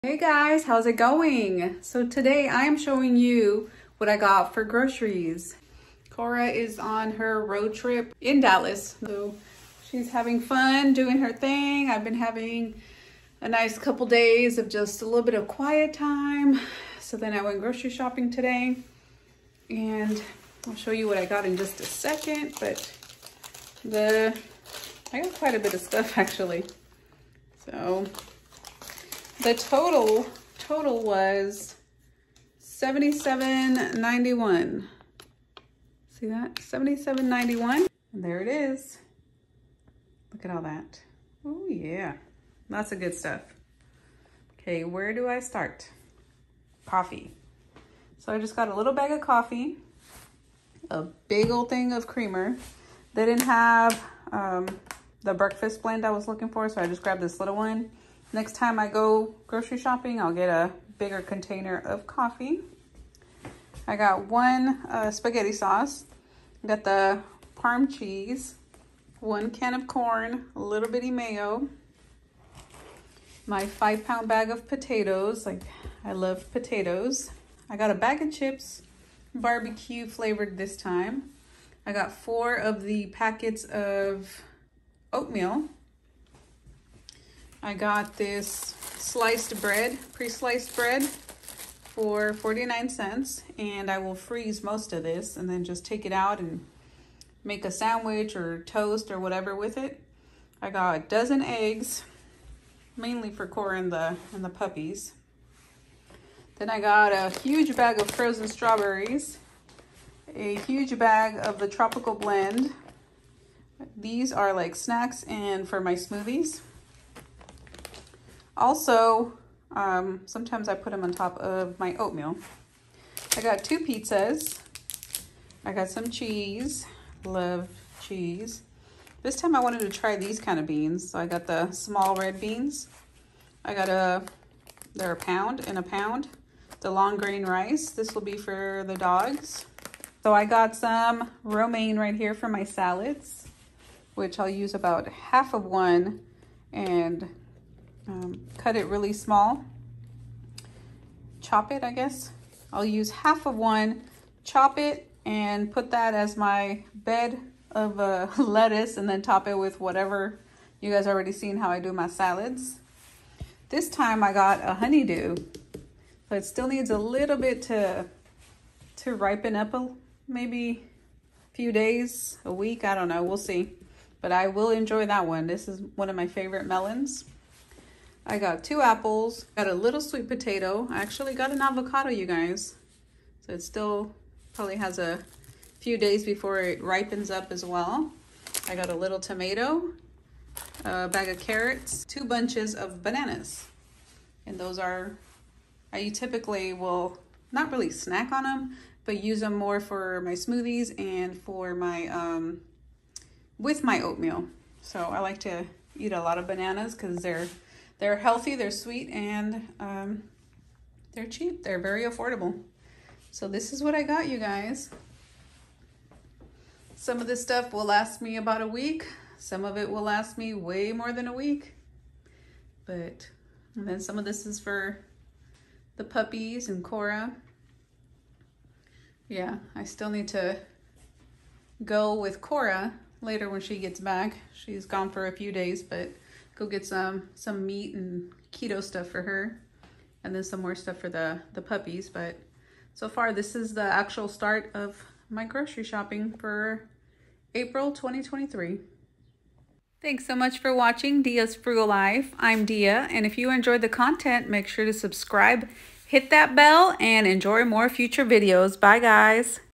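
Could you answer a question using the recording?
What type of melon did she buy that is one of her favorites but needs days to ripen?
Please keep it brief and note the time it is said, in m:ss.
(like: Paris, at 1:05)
Honeydew, at 2:44.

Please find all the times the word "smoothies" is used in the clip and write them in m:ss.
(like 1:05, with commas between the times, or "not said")
1:55, 3:20.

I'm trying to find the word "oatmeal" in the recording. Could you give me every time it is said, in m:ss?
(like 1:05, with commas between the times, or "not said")
1:25, 2:01, 3:23.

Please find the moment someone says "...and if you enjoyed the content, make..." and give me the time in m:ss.
4:13.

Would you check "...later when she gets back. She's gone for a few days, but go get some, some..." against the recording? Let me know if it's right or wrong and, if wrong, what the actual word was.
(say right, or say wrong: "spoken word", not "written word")
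right.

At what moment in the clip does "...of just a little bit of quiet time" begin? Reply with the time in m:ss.
0:14.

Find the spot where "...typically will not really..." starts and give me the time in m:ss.
3:16.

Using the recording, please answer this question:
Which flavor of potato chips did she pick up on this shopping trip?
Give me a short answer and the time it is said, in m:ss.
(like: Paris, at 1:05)
Barbecue, at 1:19.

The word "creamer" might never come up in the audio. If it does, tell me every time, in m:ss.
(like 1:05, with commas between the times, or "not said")
0:52.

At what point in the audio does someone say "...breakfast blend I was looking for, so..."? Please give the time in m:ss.
0:55.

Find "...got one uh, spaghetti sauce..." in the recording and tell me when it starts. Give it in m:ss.
1:03.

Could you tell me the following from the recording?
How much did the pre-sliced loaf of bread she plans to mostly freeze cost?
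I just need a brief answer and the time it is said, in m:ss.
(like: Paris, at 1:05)
49 cents, at 1:32.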